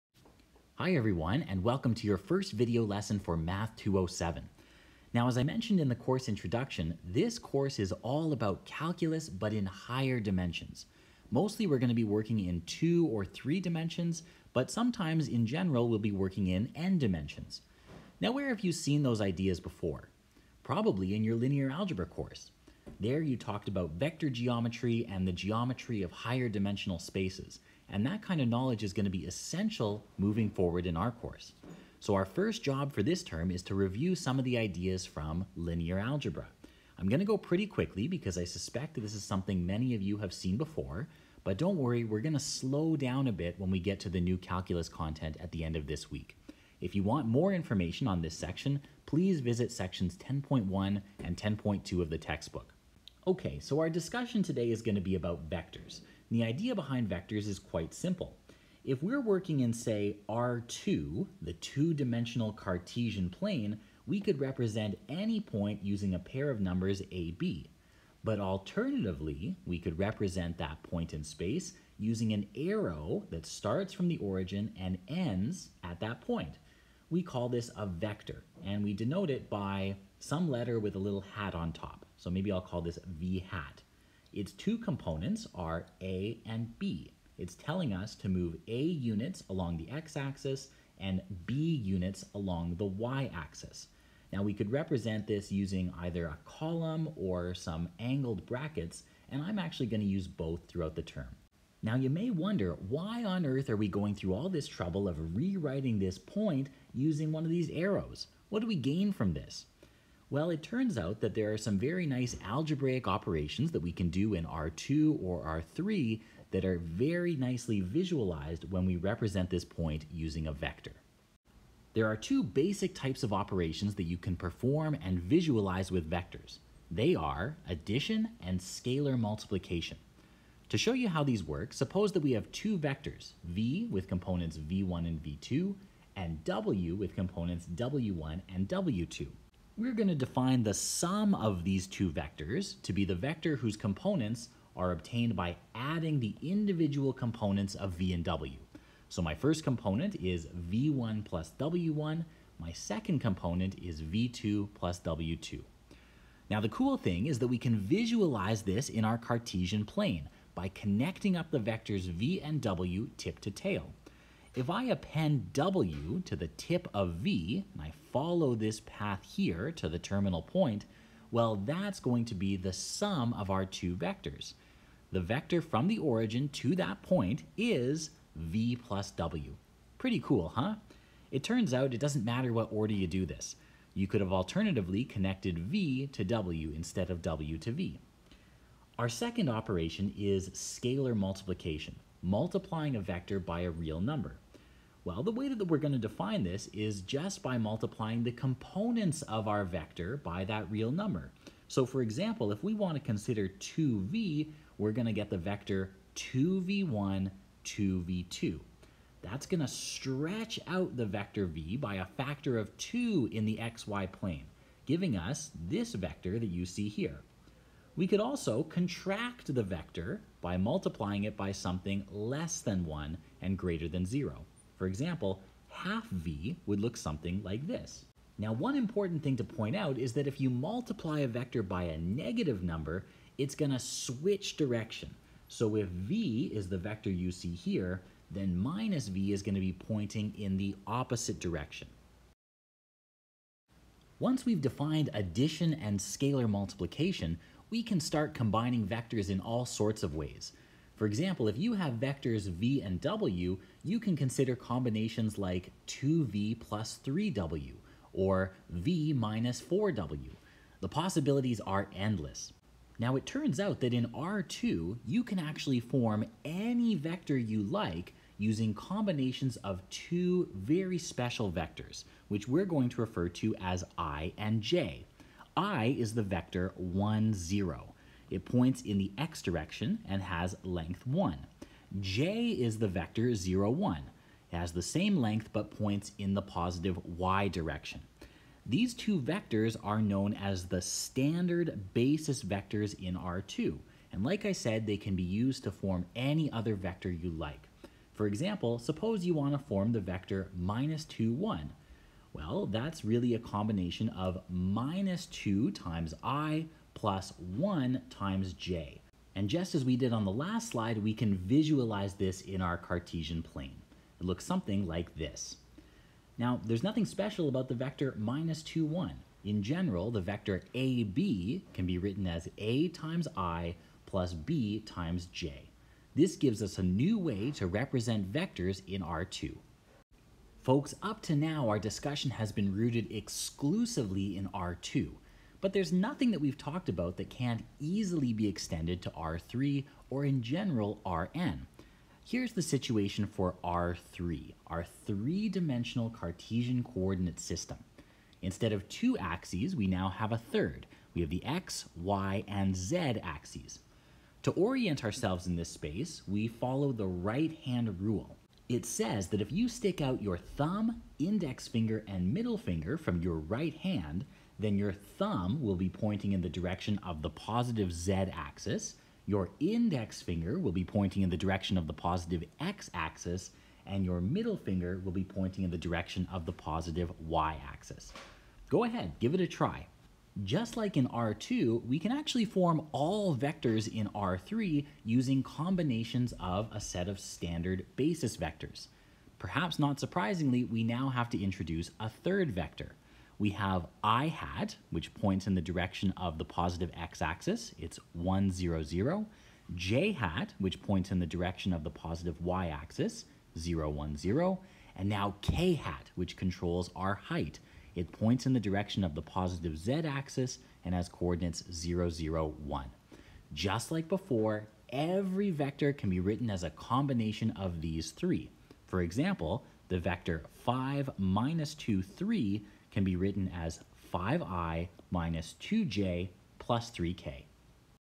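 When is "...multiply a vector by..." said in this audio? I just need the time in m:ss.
3:50.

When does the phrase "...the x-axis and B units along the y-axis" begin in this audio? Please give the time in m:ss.
1:29.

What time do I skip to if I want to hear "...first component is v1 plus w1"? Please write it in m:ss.
2:29.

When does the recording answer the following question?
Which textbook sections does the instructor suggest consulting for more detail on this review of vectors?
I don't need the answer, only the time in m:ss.
0:49.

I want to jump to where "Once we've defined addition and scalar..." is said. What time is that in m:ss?
4:04.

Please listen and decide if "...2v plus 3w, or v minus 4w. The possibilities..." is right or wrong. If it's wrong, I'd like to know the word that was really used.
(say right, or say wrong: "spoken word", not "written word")
right.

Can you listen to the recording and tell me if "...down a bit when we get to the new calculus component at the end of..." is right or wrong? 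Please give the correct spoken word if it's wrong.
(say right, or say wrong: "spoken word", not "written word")
wrong: "content", not "component".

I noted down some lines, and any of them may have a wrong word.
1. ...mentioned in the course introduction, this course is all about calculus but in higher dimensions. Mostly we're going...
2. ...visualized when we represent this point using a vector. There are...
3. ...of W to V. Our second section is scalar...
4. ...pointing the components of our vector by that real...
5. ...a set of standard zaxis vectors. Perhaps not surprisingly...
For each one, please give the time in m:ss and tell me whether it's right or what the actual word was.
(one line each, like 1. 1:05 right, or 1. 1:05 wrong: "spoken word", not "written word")
1. 0:05 right
2. 1:57 right
3. 3:07 wrong: "operation", not "section"
4. 3:17 wrong: "multiplying", not "pointing"
5. 6:26 wrong: "basis", not "zaxis".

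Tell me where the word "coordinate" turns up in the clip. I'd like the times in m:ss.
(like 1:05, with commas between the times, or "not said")
5:46, 6:51.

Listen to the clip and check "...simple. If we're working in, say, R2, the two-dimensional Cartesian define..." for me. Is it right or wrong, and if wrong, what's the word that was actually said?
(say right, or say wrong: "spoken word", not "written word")
wrong: "plane", not "define".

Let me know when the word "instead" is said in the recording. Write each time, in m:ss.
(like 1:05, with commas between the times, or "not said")
3:06, 5:48.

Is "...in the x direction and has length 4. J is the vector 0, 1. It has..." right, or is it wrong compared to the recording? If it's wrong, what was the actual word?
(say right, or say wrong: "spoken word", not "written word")
wrong: "1", not "4".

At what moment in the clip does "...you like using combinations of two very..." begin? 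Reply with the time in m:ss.
4:27.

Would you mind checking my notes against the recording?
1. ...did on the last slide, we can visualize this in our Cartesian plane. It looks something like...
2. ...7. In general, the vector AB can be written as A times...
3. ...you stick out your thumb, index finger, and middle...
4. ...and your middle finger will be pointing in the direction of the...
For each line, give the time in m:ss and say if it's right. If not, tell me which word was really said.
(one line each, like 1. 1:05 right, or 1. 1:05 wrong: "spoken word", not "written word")
1. 5:09 right
2. 5:18 wrong: "1", not "7"
3. 5:59 right
4. 6:13 right.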